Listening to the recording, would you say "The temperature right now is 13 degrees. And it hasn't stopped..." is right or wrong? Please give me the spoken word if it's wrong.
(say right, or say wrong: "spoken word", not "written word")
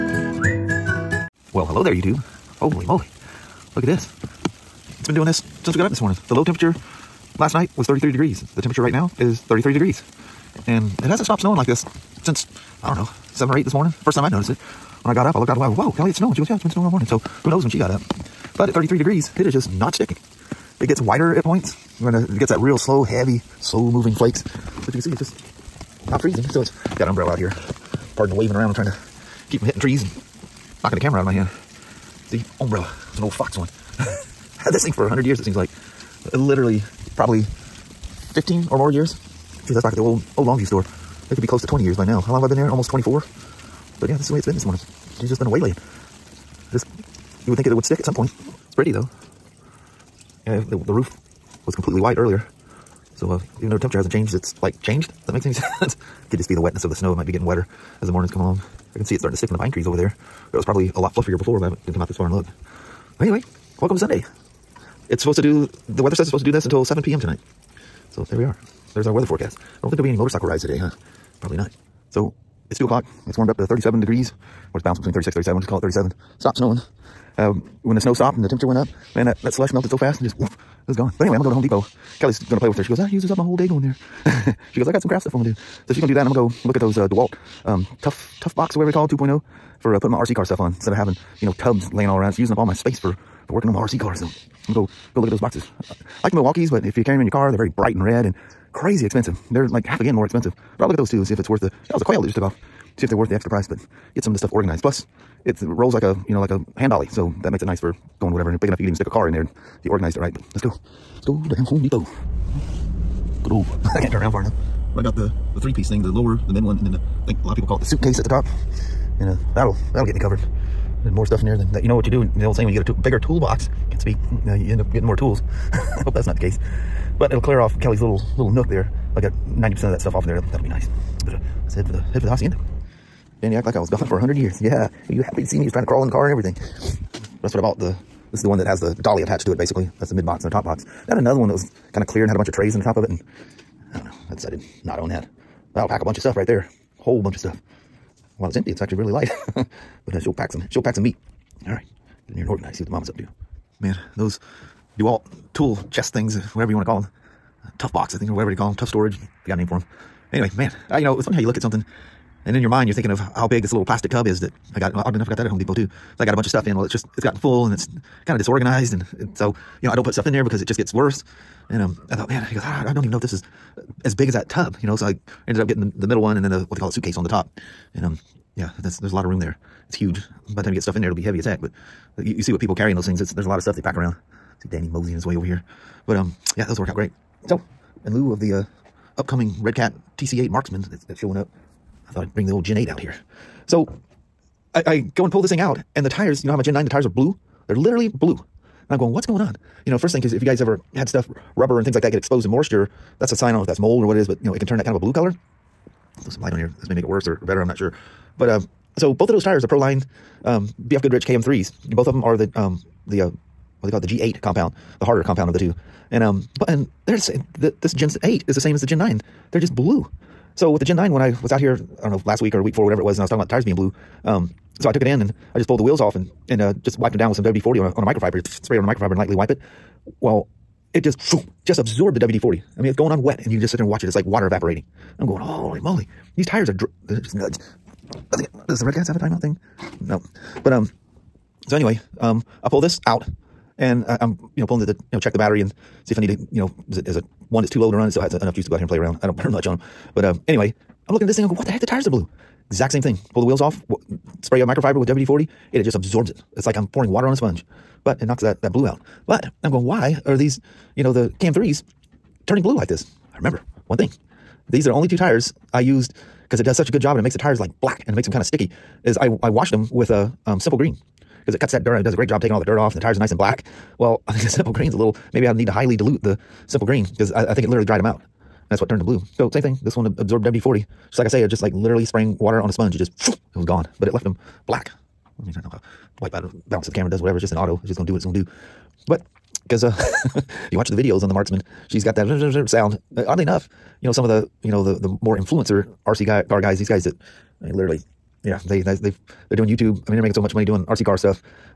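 wrong: "33", not "13".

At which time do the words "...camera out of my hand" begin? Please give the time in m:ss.
0:30.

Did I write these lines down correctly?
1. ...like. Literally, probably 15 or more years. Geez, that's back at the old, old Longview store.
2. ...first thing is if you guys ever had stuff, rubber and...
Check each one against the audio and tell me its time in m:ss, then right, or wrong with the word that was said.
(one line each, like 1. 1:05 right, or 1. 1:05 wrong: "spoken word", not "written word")
1. 0:35 right
2. 3:19 right.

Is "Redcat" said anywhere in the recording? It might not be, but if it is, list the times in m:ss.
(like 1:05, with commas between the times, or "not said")
3:09, 3:58.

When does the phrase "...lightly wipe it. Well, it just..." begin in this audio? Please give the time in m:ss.
3:49.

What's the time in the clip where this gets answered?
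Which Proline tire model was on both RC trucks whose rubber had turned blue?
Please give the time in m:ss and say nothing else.
3:30.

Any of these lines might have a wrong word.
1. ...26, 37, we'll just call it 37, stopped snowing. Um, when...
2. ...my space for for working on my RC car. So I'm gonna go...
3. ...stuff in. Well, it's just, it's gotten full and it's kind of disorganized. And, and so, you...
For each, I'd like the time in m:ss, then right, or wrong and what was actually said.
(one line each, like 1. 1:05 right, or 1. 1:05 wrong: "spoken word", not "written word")
1. 1:15 wrong: "36", not "26"
2. 1:32 right
3. 2:46 right.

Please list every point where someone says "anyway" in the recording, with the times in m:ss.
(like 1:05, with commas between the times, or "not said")
1:03, 1:21, 2:40, 4:01, 4:10.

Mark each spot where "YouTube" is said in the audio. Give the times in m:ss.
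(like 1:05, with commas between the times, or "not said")
0:01, 4:59.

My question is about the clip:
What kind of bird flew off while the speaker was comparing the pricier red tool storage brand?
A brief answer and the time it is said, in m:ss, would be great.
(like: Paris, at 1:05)
quail, at 1:42.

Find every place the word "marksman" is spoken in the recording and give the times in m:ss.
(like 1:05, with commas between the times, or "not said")
3:10, 4:51.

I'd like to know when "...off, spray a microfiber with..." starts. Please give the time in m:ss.
4:13.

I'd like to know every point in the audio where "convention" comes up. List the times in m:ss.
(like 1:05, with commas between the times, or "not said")
not said.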